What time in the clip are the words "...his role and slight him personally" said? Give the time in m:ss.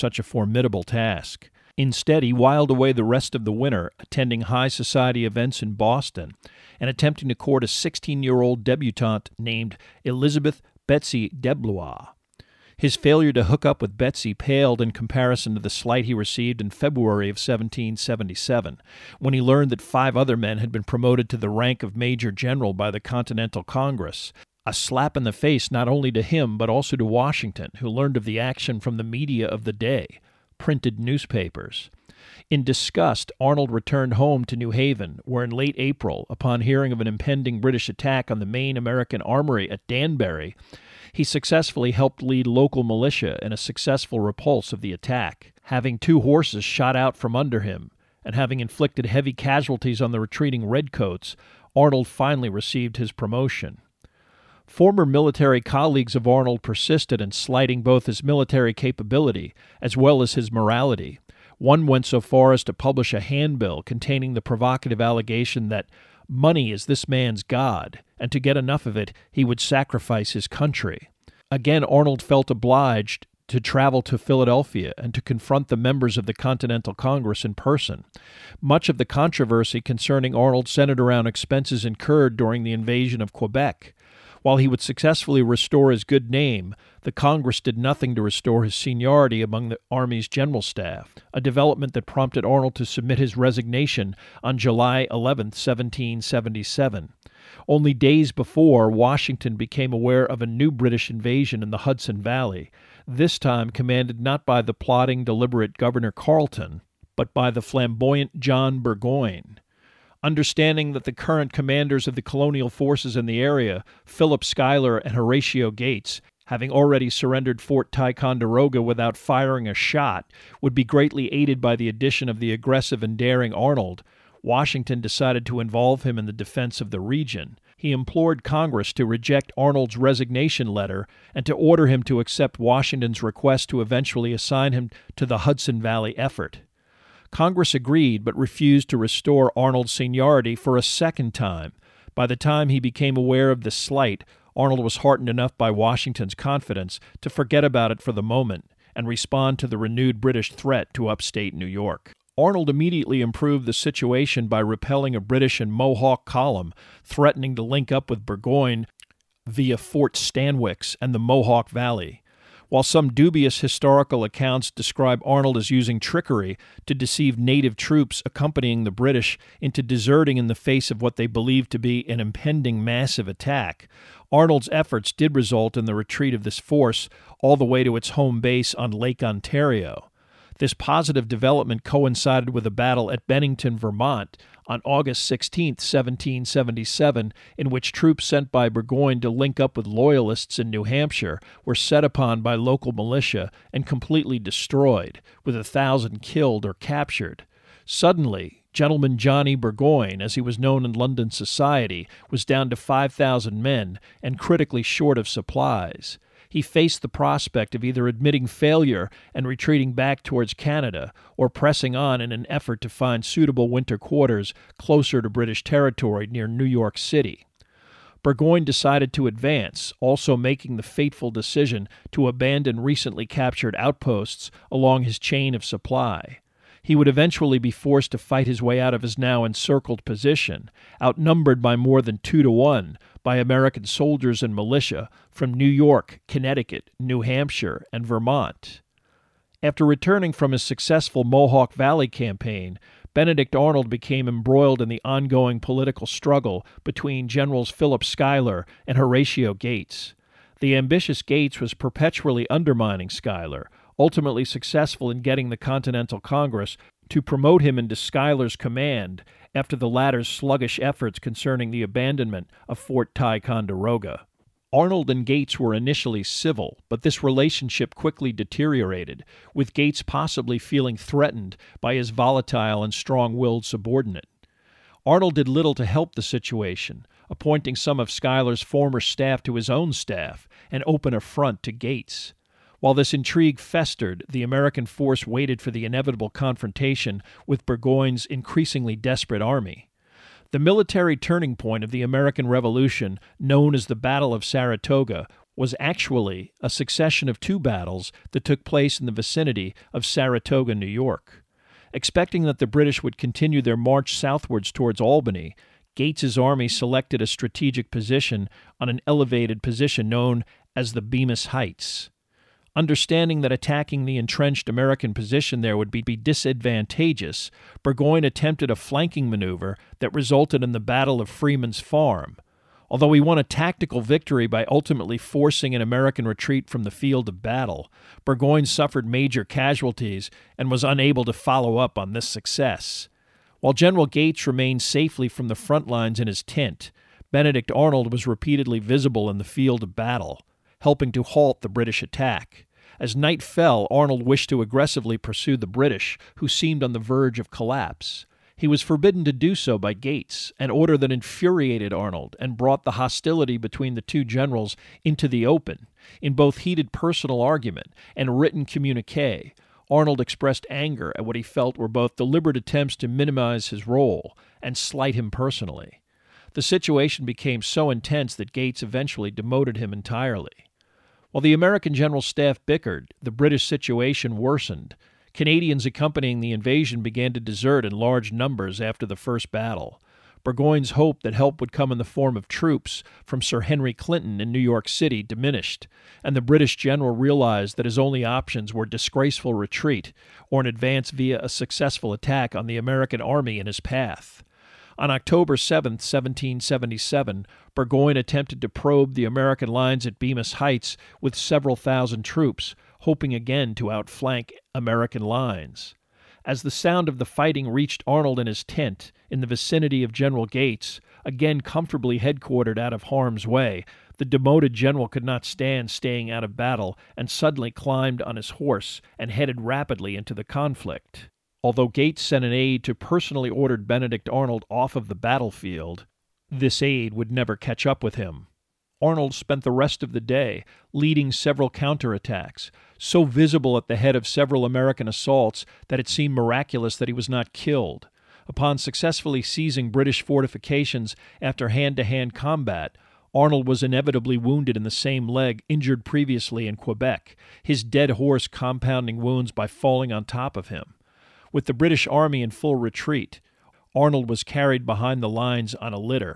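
6:03.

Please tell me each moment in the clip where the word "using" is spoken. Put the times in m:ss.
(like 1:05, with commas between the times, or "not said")
2:45.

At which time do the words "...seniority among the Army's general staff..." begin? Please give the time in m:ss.
1:28.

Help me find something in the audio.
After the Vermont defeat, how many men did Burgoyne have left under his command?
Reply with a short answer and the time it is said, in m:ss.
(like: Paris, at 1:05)
5,000, at 3:22.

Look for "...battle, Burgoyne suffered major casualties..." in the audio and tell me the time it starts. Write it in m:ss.
5:27.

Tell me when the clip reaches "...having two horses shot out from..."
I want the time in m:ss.
0:45.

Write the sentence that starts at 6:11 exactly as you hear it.
While the American general staff bickered, the British situation worsened.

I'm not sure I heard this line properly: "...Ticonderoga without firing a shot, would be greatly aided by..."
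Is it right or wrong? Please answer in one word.
right.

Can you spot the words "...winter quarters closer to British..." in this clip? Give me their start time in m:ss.
3:33.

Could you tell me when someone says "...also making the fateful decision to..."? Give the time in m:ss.
3:39.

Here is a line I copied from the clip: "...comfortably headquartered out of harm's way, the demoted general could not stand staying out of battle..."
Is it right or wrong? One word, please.
right.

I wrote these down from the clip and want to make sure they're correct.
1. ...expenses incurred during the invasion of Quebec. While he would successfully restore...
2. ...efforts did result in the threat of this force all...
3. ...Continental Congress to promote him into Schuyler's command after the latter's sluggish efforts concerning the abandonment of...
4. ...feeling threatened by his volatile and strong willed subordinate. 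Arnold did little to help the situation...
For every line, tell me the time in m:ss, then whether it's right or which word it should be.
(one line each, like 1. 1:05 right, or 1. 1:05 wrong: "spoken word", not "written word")
1. 1:21 right
2. 2:54 wrong: "retreat", not "threat"
3. 4:15 right
4. 4:30 right.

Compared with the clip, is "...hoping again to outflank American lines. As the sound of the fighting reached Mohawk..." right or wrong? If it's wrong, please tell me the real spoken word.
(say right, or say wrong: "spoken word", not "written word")
wrong: "Arnold", not "Mohawk".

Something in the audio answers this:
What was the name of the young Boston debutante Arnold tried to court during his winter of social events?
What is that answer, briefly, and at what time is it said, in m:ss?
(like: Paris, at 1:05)
Elizabeth Betsy Deblois, at 0:10.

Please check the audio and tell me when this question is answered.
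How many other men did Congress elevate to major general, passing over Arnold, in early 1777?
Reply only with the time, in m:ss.
0:19.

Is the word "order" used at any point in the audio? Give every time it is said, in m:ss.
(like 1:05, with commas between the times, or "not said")
2:11, 5:50, 7:03.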